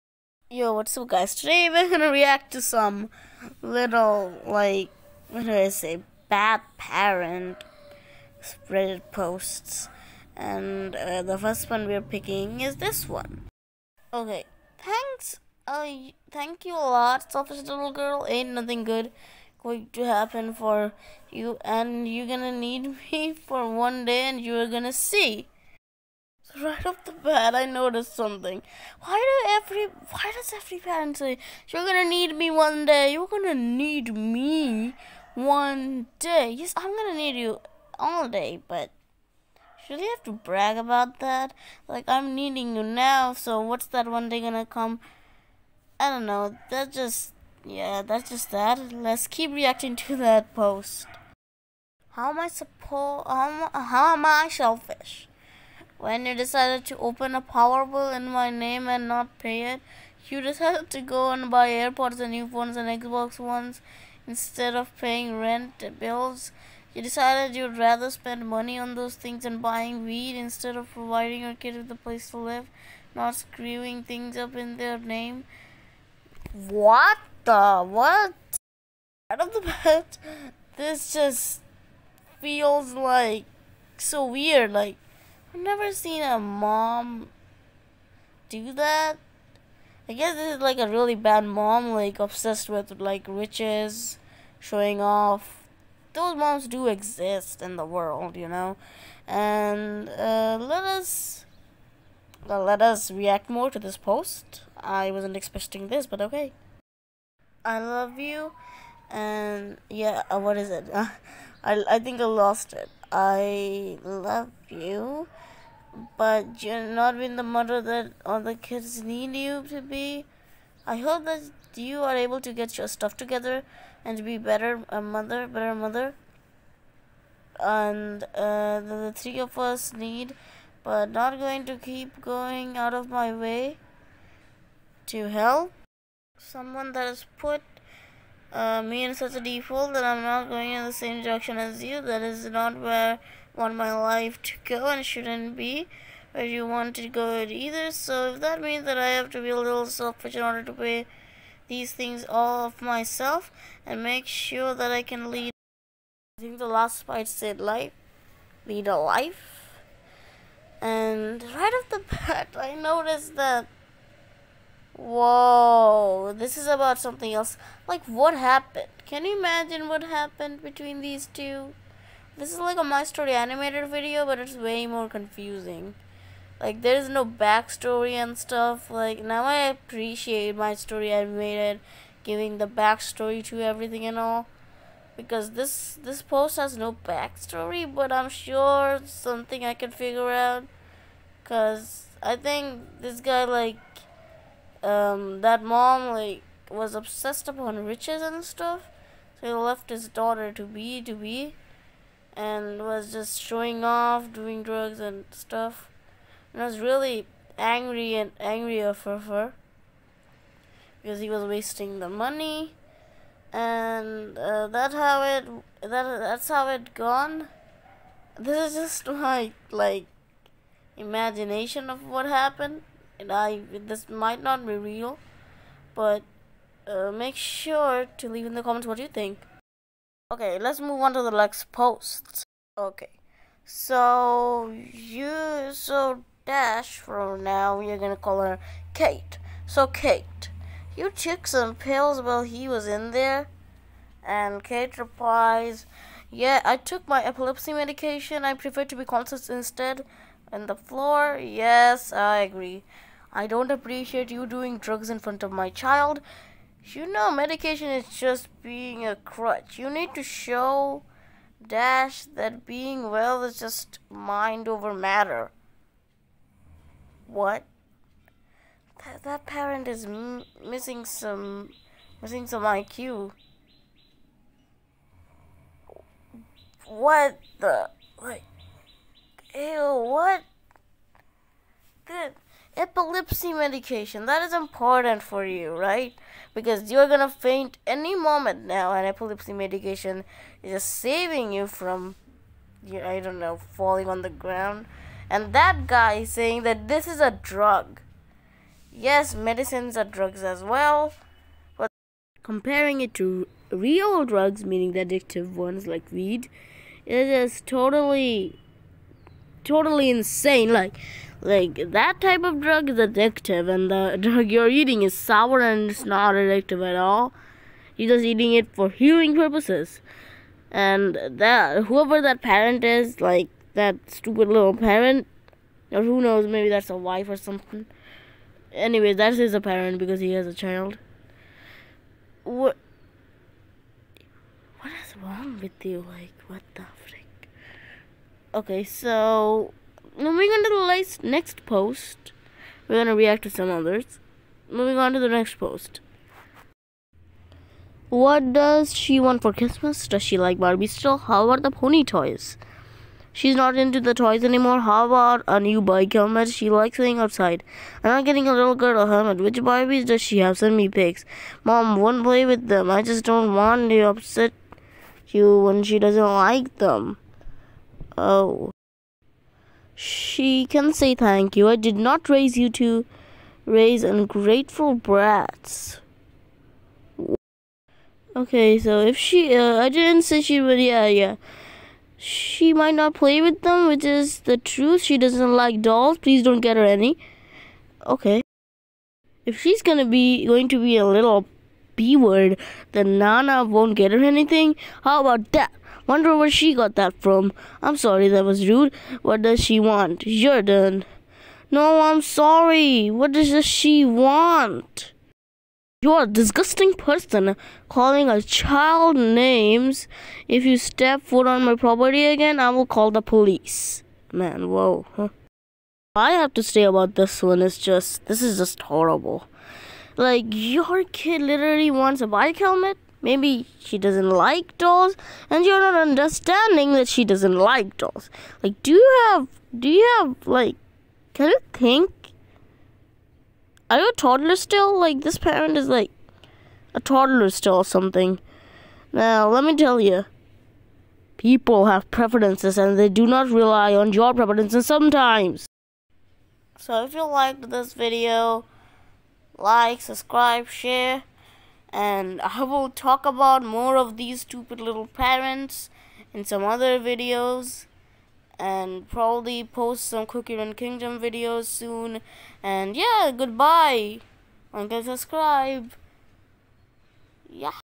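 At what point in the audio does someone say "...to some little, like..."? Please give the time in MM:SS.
00:02.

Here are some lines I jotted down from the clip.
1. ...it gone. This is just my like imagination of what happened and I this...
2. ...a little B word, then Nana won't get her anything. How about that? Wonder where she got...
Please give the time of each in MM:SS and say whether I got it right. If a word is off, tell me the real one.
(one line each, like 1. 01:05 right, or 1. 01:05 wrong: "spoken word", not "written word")
1. 03:36 right
2. 06:30 right.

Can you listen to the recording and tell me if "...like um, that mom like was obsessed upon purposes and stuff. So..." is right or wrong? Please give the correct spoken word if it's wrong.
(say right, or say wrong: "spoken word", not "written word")
wrong: "riches", not "purposes".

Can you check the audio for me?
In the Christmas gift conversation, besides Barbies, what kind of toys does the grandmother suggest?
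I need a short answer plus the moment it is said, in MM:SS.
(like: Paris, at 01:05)
Pony toys, at 05:51.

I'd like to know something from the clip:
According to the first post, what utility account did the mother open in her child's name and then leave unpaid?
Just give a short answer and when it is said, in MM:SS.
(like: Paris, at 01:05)
Power bill, at 00:57.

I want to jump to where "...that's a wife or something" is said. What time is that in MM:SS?
05:26.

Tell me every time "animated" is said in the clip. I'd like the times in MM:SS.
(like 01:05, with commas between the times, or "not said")
02:53, 03:01.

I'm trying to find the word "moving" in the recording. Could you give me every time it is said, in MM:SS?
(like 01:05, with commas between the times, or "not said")
05:40, 05:44.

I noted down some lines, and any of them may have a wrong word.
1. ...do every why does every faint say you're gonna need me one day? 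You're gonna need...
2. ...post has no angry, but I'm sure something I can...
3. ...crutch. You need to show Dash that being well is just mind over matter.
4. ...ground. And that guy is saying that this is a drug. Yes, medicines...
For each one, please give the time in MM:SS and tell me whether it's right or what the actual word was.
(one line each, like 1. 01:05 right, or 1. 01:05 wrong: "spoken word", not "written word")
1. 00:29 wrong: "parent", not "faint"
2. 03:06 wrong: "backstory", not "angry"
3. 04:19 right
4. 04:54 right.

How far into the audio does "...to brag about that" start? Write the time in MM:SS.
00:40.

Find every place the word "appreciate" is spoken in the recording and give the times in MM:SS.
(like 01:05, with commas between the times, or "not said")
02:59, 04:13.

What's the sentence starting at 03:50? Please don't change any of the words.
Okay, let's move on to the next post.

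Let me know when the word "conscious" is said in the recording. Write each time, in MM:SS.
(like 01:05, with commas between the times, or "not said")
04:09.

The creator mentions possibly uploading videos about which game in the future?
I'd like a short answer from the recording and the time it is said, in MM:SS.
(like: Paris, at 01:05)
Cookie Run Kingdom, at 07:40.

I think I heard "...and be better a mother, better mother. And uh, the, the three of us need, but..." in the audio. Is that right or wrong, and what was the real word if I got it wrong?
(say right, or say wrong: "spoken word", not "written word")
right.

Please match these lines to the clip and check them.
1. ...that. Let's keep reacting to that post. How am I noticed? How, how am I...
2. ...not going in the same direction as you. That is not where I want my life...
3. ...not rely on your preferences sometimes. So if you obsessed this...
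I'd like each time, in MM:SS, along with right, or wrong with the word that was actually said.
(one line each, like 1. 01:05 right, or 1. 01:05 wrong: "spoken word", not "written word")
1. 00:48 wrong: "supposed", not "noticed"
2. 02:20 right
3. 07:23 wrong: "liked", not "obsessed".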